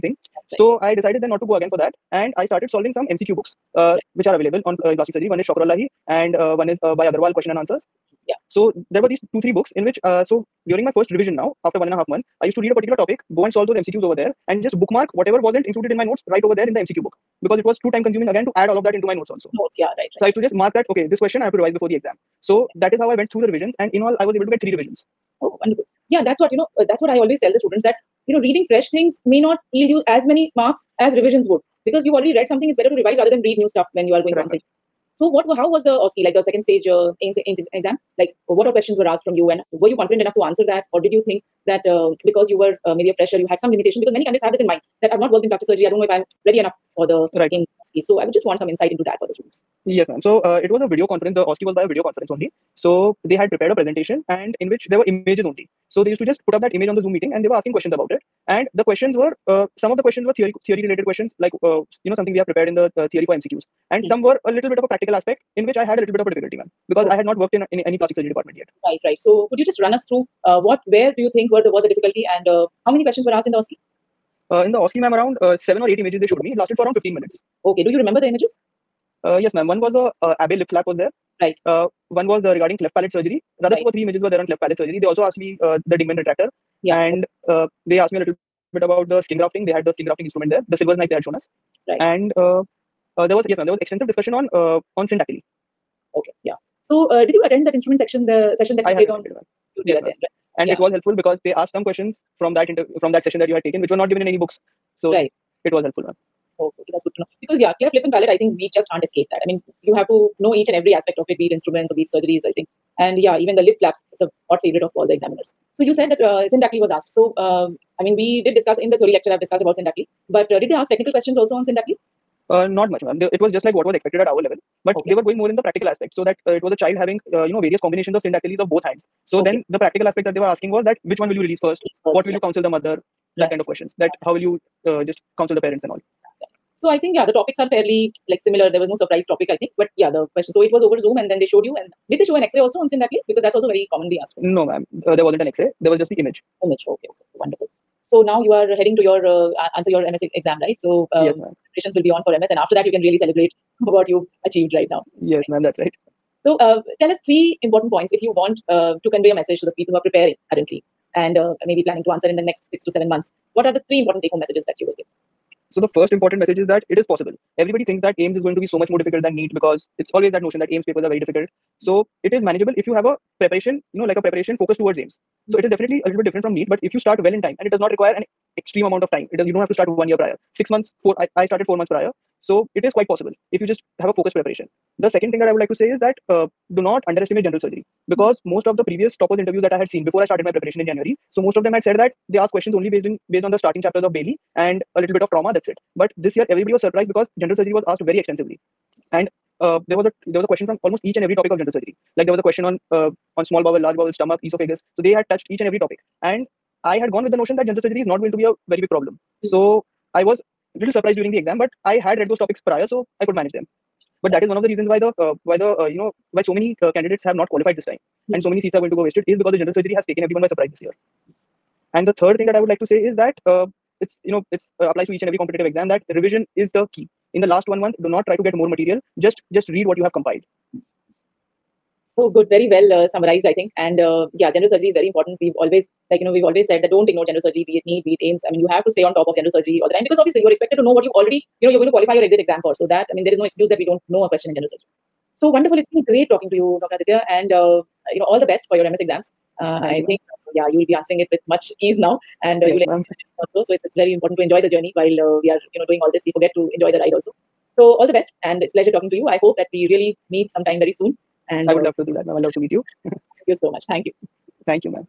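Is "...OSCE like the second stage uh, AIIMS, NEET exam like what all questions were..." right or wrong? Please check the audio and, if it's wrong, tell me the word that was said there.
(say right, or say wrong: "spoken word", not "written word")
wrong: "AIIMS", not "NEET".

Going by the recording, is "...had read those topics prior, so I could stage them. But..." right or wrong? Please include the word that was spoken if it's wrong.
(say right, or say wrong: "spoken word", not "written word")
wrong: "manage", not "stage".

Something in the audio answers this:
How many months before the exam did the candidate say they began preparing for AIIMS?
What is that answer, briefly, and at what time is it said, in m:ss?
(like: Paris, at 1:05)
4, at 3:01.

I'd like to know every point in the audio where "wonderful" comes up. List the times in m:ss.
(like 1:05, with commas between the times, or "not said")
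0:25, 2:27, 4:05.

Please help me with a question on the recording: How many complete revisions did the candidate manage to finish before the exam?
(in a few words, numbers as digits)
3.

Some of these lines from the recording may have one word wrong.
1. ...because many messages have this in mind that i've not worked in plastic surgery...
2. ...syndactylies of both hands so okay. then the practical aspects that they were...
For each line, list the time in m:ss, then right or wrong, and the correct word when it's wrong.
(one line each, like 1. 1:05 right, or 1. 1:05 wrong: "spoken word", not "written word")
1. 0:44 wrong: "candidates", not "messages"
2. 2:08 right.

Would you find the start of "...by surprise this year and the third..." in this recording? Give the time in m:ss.
3:40.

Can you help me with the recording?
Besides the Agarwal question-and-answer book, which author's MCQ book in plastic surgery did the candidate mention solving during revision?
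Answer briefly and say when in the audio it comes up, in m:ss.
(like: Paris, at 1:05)
Shokrollahi, at 0:05.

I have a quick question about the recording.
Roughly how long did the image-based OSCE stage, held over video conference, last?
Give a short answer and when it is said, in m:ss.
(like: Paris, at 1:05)
15 minutes, at 1:16.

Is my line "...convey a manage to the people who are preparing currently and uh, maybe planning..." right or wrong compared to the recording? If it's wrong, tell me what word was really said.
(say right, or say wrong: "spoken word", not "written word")
wrong: "message", not "manage".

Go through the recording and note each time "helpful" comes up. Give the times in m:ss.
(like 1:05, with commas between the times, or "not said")
1:40, 1:45.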